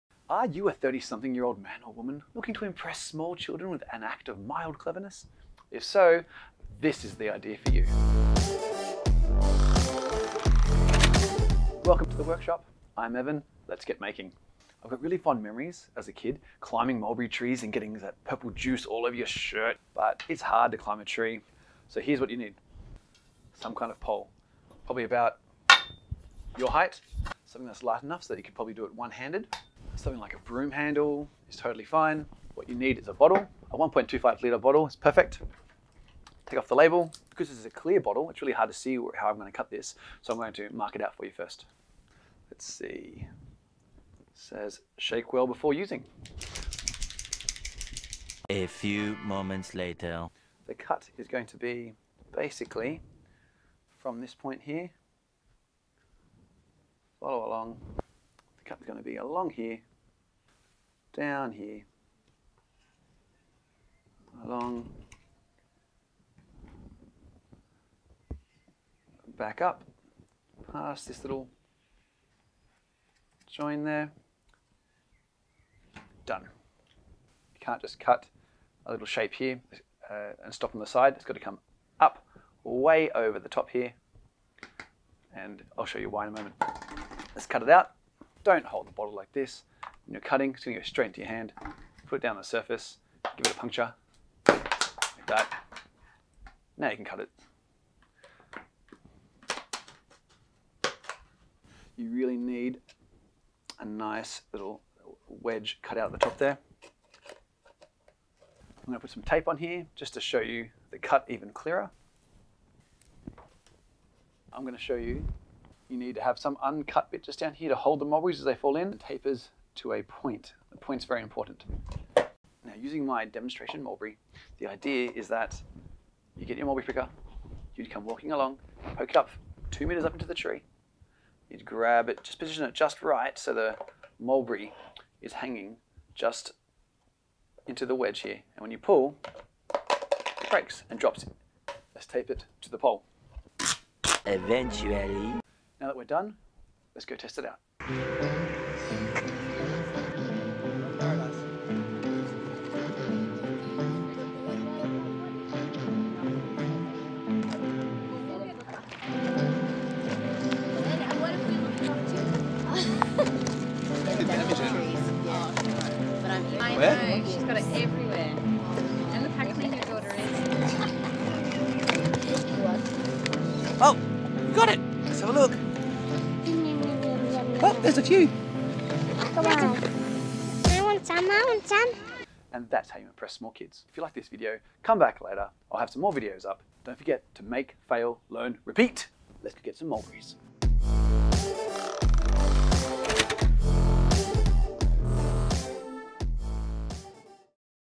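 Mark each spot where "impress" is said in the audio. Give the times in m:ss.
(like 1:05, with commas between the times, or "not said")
0:02, 3:03.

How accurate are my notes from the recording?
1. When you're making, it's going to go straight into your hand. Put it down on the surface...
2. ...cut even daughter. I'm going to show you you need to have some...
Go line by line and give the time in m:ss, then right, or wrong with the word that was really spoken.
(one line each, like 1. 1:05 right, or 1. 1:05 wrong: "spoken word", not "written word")
1. 1:30 wrong: "cutting", not "making"
2. 1:50 wrong: "clearer", not "daughter".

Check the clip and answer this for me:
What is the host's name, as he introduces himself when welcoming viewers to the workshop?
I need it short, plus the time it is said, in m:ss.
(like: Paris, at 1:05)
Evan, at 0:13.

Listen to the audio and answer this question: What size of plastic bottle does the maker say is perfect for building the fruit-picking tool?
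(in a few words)
1.25 litre.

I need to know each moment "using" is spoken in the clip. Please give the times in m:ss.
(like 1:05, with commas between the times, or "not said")
0:45, 2:02.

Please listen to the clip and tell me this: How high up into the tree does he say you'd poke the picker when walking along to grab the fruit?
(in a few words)
2 meters.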